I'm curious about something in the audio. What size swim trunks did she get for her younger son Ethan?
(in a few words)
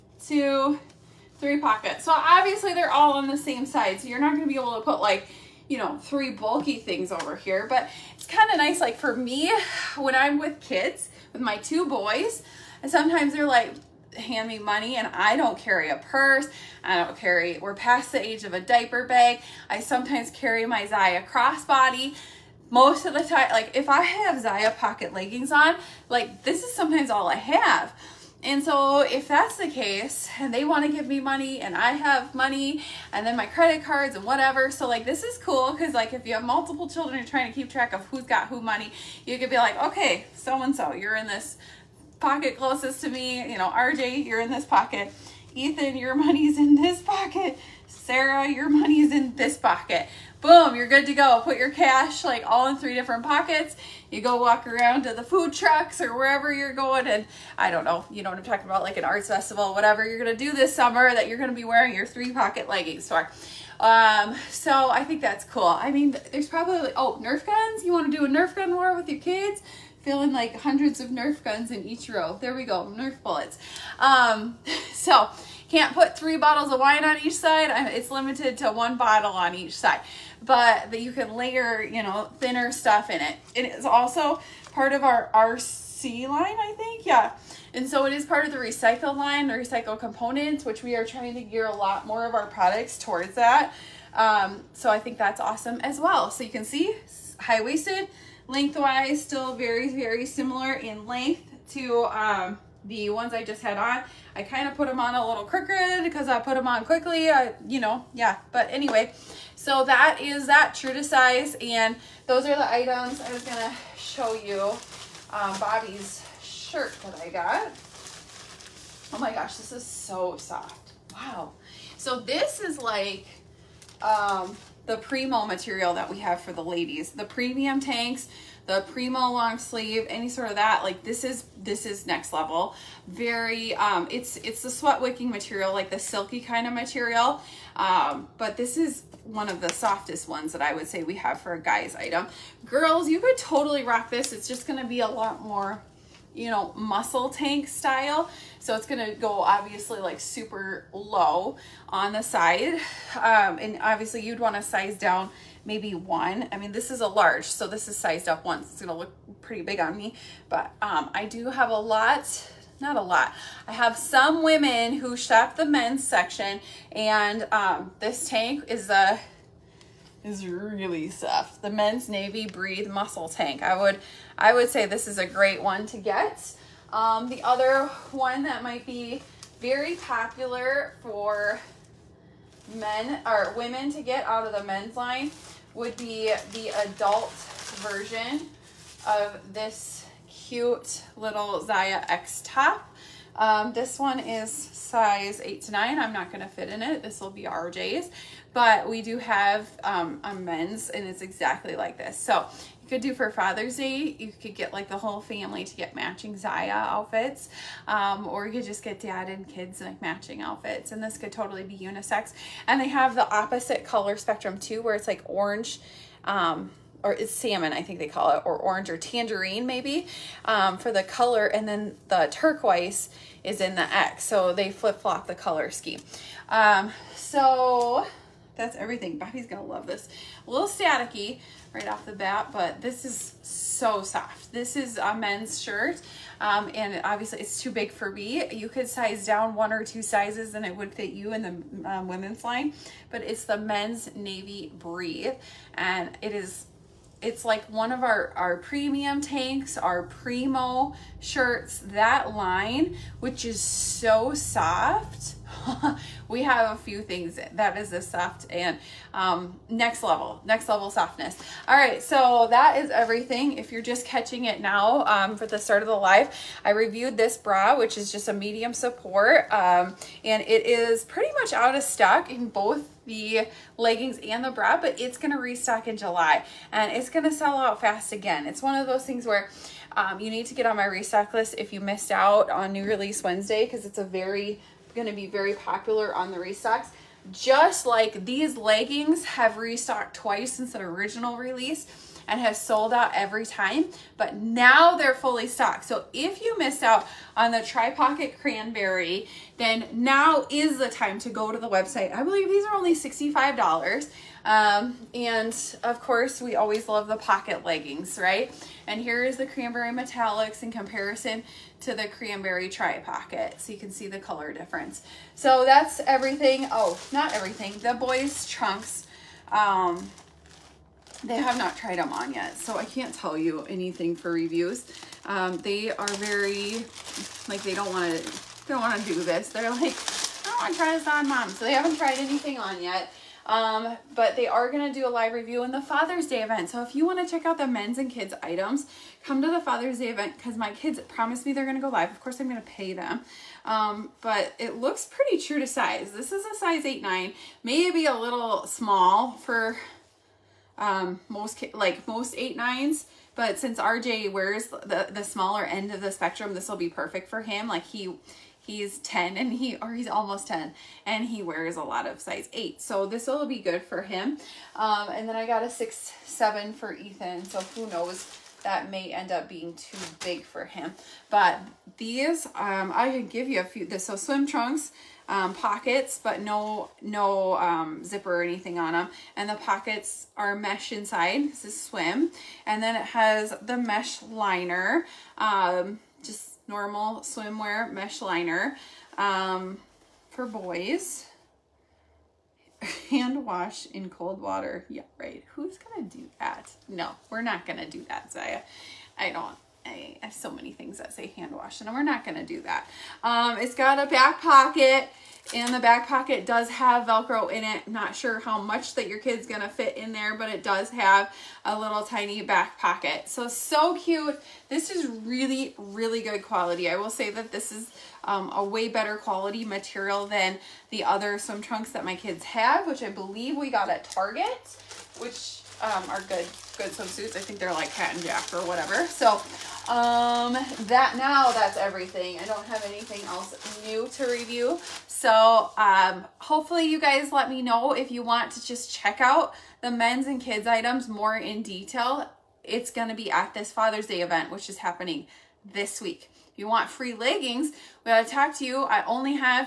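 6-7.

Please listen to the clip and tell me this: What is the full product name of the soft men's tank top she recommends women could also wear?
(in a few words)
Men's navy breathe muscle tank.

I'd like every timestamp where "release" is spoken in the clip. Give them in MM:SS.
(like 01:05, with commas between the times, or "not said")
04:42, 04:51.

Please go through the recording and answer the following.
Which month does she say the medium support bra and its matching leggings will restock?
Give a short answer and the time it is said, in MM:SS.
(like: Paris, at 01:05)
July, at 04:35.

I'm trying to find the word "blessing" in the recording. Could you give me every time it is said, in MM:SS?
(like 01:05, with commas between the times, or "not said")
not said.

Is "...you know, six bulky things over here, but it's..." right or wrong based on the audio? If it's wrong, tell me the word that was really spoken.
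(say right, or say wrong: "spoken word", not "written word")
wrong: "three", not "six".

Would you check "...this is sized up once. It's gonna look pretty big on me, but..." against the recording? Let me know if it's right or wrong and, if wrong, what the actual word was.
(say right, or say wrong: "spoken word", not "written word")
right.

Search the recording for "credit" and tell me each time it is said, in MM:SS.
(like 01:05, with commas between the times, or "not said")
00:33.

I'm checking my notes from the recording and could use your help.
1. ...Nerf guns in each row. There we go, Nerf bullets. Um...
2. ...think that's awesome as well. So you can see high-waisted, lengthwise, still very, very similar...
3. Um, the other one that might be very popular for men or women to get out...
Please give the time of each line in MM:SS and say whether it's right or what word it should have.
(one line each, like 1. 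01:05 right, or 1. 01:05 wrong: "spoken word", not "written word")
1. 01:11 right
2. 01:34 right
3. 02:56 right.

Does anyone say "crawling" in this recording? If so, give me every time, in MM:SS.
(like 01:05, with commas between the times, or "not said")
not said.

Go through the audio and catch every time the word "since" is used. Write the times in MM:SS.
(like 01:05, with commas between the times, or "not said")
04:50, 05:53.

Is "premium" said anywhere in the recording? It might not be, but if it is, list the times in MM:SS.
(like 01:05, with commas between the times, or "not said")
02:07, 04:08.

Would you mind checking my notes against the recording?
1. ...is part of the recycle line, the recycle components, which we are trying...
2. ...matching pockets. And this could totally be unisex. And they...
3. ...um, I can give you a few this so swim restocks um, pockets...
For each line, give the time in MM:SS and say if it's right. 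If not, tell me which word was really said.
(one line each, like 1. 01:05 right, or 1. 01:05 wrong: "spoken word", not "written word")
1. 01:28 right
2. 03:29 wrong: "outfits", not "pockets"
3. 06:12 wrong: "trunks", not "restocks".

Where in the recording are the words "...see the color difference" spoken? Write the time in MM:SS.
05:13.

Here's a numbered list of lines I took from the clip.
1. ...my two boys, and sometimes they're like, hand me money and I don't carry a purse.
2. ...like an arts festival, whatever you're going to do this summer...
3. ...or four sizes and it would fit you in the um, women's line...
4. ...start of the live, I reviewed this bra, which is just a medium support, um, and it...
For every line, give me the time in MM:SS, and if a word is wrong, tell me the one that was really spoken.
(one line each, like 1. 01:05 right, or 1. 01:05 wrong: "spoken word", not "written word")
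1. 00:11 right
2. 00:58 right
3. 03:59 wrong: "two", not "four"
4. 04:25 right.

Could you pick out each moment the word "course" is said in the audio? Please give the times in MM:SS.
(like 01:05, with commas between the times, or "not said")
05:06, 05:42.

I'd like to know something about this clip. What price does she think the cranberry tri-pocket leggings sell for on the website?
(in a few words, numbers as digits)
$65.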